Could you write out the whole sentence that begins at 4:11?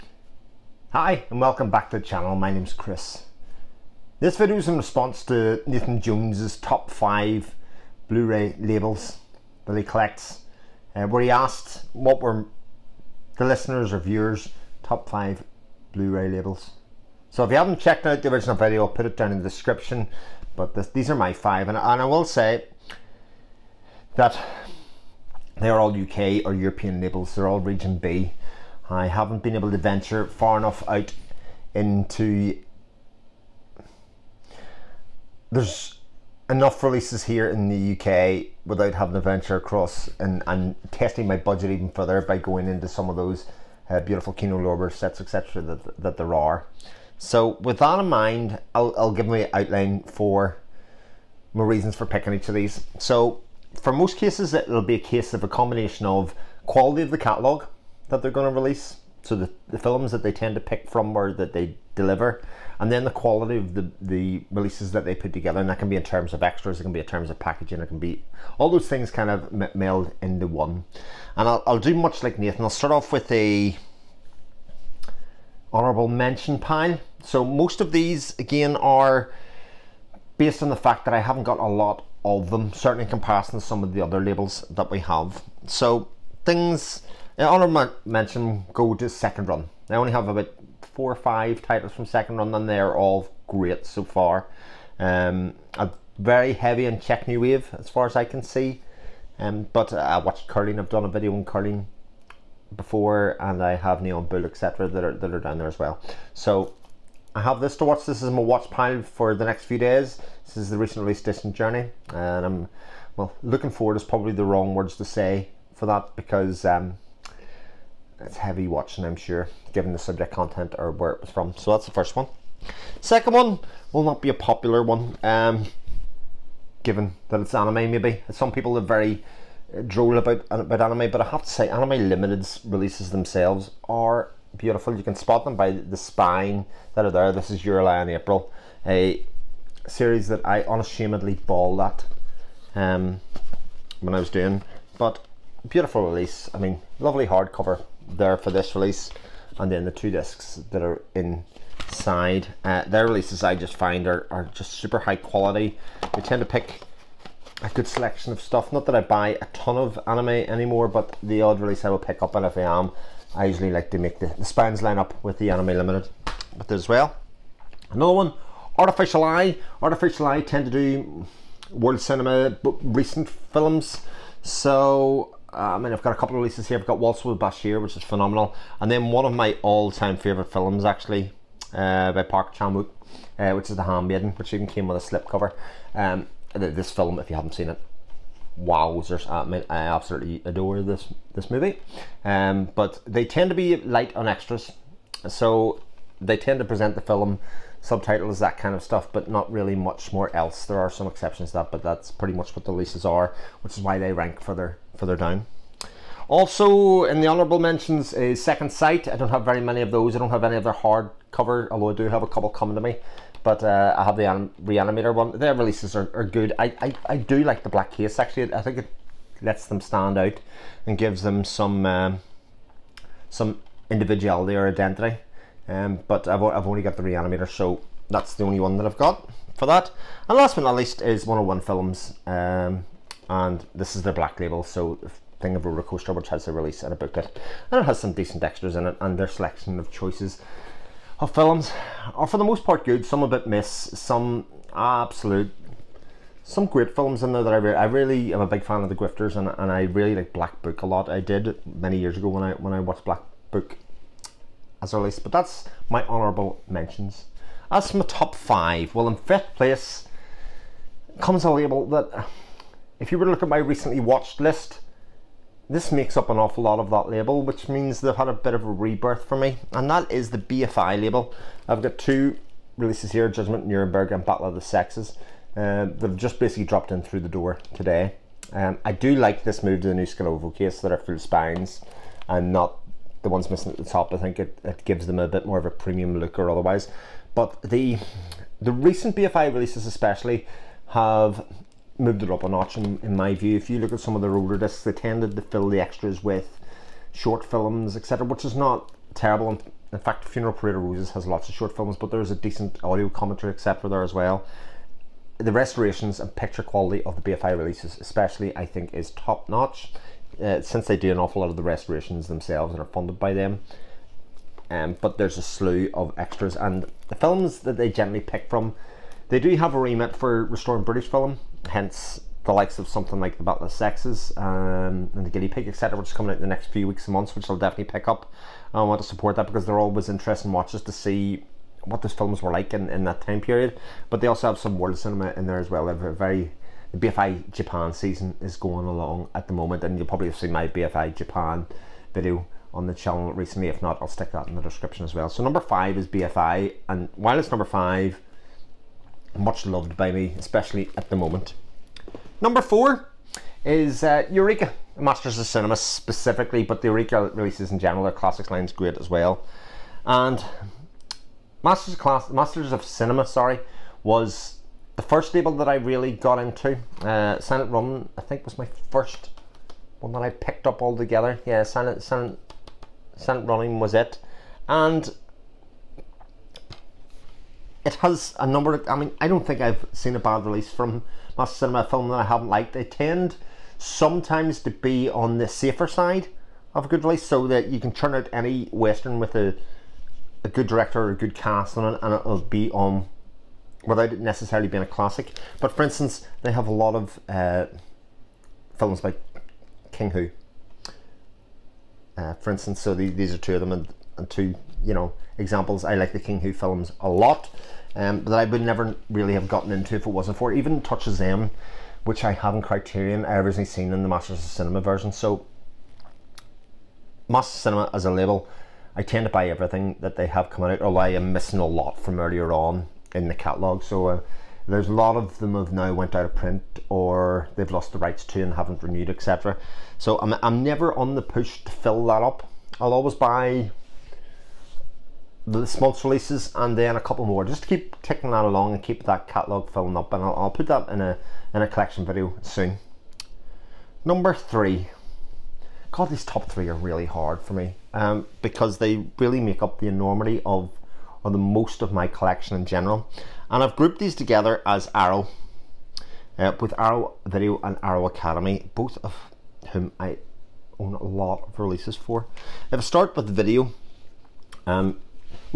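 I did many years ago when I when I watched Black Book as a release, but that's my honourable mentions.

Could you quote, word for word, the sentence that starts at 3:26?
Also in the honourable mentions is Second Sight.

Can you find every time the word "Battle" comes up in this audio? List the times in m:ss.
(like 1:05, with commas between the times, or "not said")
4:34, 5:23.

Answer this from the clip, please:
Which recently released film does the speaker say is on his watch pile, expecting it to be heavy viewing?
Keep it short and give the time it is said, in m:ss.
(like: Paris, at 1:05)
Distant Journey, at 1:51.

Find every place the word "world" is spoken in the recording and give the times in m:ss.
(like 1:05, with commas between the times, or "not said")
2:51, 5:34.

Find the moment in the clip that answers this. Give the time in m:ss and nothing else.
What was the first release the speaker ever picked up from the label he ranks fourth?
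6:13.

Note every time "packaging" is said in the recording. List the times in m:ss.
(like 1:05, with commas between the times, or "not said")
1:07.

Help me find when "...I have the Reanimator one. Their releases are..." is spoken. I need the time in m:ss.
3:33.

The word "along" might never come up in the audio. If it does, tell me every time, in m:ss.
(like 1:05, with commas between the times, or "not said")
5:38, 7:18.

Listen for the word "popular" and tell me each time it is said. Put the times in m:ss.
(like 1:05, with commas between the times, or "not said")
2:04.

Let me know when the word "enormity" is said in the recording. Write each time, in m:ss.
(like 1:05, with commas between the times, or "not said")
7:29.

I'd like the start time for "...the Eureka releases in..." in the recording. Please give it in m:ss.
5:56.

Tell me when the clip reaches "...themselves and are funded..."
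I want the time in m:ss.
5:12.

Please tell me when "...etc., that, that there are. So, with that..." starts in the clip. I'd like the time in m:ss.
0:45.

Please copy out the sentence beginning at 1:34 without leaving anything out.
Um, very heavy on Czech New Wave as far as I can see.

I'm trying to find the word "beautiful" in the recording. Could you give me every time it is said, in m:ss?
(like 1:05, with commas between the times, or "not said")
0:43, 2:14, 2:25.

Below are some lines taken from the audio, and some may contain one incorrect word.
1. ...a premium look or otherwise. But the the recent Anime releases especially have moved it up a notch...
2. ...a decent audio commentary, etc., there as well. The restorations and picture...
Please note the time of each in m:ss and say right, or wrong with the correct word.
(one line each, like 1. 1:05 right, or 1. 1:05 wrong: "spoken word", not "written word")
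1. 4:45 wrong: "BFI", not "Anime"
2. 5:02 right.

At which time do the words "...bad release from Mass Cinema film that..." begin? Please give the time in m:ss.
6:20.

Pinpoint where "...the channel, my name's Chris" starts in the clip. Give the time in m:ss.
0:01.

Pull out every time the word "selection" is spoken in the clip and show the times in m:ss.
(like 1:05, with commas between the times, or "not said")
2:37, 3:59.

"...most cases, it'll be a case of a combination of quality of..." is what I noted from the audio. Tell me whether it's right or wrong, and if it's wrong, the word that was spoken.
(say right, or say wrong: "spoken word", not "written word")
right.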